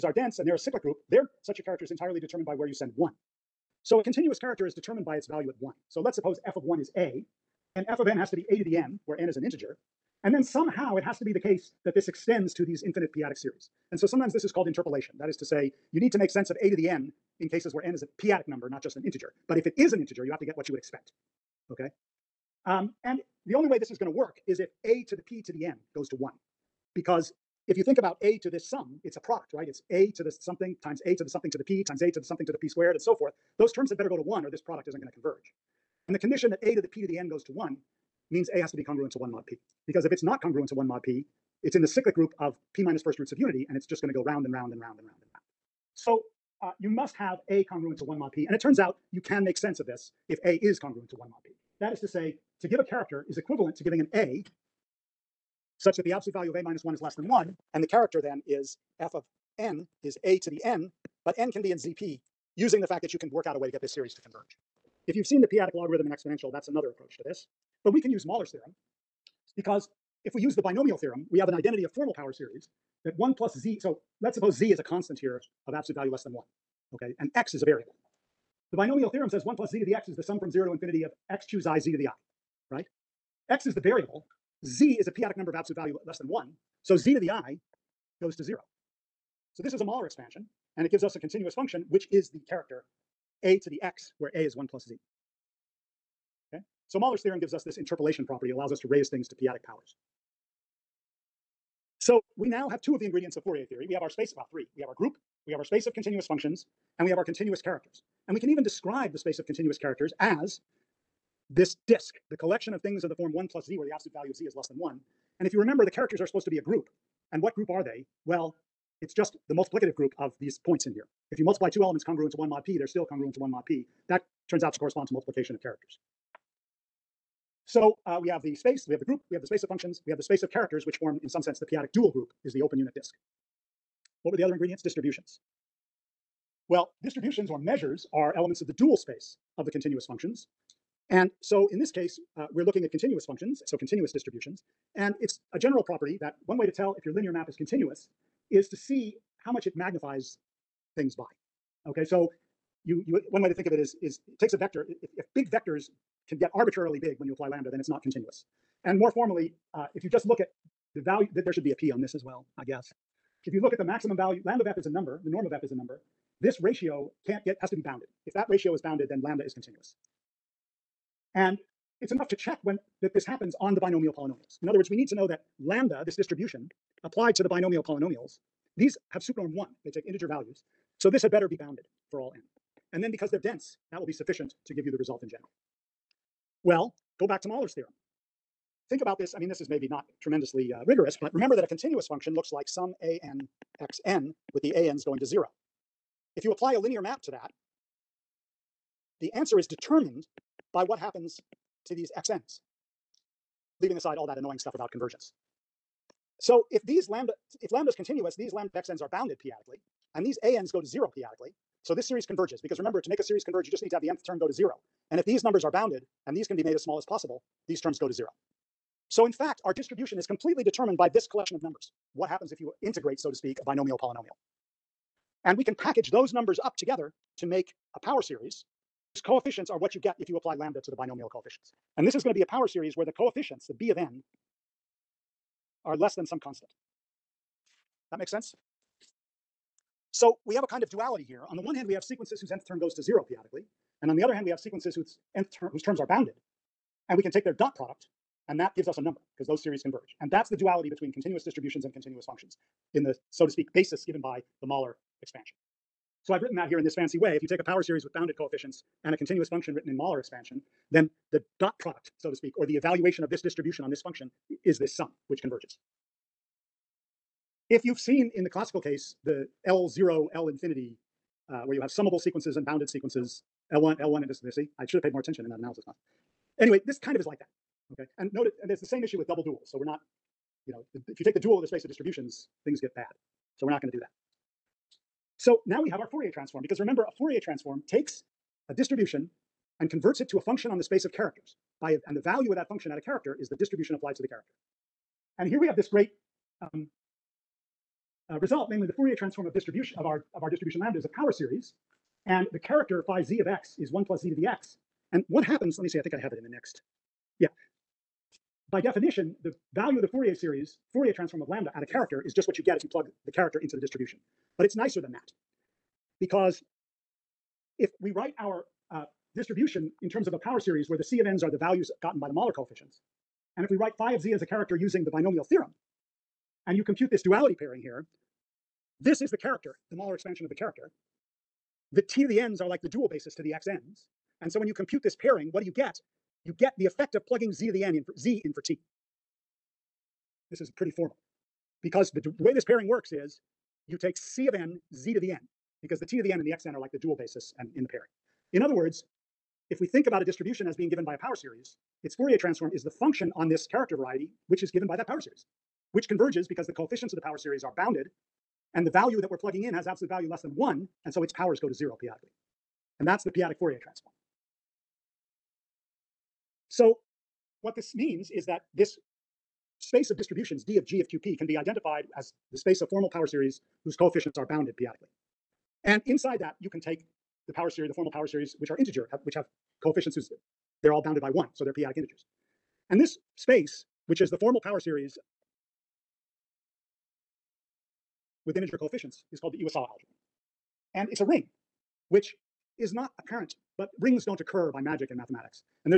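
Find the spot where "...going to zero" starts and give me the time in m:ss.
3:15.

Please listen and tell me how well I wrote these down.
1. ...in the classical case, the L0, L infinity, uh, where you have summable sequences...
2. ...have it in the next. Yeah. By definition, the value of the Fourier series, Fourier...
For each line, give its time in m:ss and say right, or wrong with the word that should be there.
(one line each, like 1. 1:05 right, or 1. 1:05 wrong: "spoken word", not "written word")
1. 4:28 right
2. 5:06 right.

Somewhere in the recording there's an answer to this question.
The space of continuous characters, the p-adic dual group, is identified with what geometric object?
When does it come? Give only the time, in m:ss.
2:12.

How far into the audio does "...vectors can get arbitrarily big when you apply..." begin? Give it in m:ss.
2:35.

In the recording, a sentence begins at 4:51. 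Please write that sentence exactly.
By and the value of that function at a character is the distribution applied to the character.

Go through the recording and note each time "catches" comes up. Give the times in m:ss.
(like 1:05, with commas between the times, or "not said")
not said.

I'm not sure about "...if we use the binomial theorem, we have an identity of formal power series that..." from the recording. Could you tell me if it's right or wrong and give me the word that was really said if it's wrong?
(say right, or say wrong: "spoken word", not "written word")
right.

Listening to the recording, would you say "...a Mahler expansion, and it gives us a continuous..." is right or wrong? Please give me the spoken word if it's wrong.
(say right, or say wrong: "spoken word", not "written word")
right.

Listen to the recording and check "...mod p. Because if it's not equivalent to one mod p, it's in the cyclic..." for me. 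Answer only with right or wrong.
wrong.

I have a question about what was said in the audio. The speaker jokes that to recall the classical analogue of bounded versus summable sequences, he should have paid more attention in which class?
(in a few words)
Analysis class.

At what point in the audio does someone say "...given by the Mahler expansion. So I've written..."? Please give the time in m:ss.
4:14.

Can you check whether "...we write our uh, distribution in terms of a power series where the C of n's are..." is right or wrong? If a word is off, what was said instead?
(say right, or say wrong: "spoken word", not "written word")
right.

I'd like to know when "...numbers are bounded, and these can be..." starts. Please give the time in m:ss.
3:35.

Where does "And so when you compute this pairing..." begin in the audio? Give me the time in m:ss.
5:34.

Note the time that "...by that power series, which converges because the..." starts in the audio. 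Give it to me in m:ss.
5:54.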